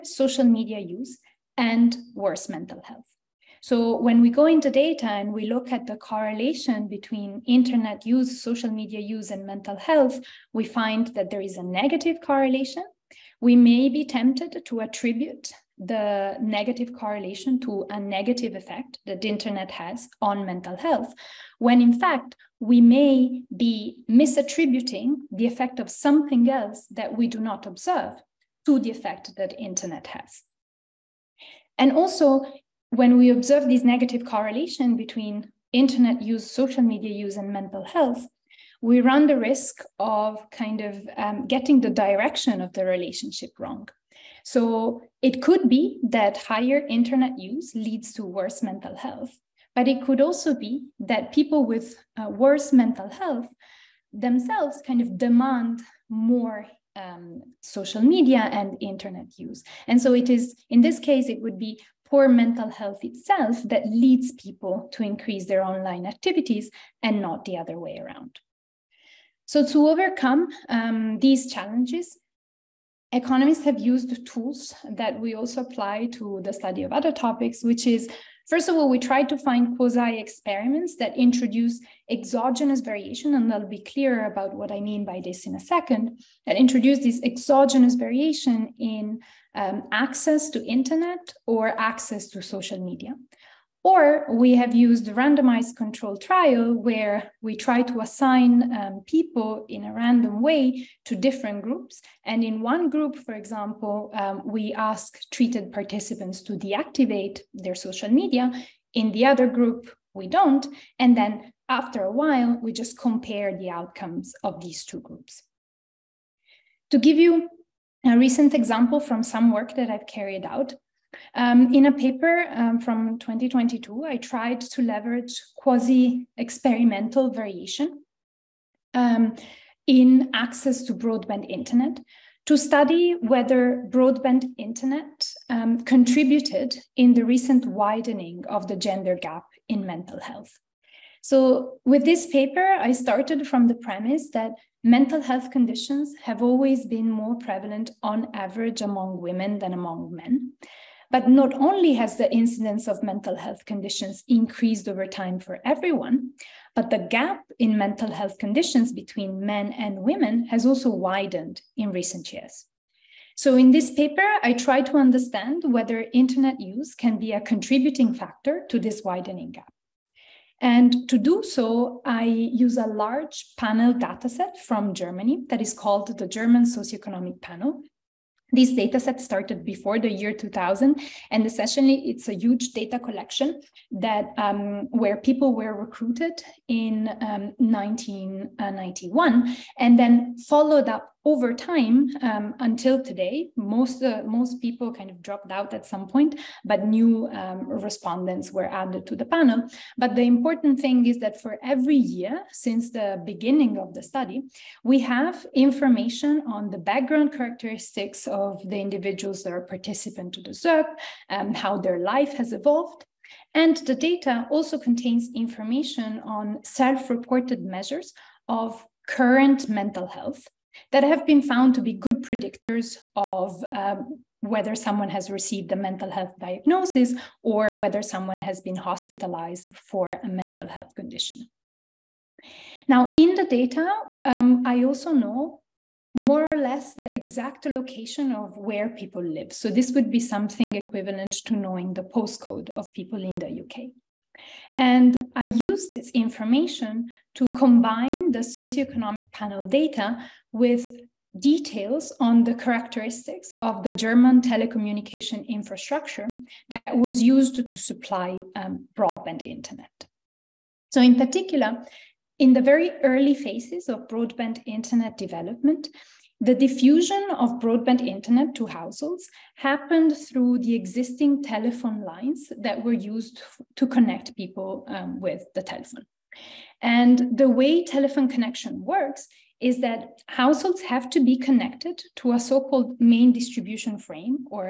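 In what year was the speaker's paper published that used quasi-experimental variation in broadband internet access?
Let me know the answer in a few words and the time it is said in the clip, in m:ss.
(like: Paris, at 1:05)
2022, at 2:03.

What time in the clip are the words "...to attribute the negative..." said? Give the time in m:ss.
0:14.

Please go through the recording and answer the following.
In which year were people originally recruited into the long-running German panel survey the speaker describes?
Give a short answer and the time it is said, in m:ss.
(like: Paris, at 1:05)
1991, at 3:07.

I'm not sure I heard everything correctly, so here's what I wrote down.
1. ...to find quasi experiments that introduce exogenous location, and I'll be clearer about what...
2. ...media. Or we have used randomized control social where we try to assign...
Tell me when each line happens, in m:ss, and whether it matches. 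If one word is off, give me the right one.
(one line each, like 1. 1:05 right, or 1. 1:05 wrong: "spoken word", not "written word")
1. 1:19 wrong: "variation", not "location"
2. 1:32 wrong: "trial", not "social".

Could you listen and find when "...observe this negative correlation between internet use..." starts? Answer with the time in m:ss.
0:33.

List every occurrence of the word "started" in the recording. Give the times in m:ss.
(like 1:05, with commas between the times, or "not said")
2:22, 2:59.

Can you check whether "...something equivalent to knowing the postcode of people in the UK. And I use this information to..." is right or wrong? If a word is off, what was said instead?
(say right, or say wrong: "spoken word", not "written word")
right.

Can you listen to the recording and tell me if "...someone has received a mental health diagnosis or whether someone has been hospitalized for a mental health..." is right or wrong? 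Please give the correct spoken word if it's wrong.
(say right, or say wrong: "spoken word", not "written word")
right.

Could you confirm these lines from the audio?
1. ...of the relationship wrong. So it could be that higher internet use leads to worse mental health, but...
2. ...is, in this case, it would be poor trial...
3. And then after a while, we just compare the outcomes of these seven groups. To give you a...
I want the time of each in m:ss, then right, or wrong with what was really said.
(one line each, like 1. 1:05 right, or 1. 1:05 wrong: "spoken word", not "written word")
1. 0:42 right
2. 1:00 wrong: "mental", not "trial"
3. 1:51 wrong: "two", not "seven".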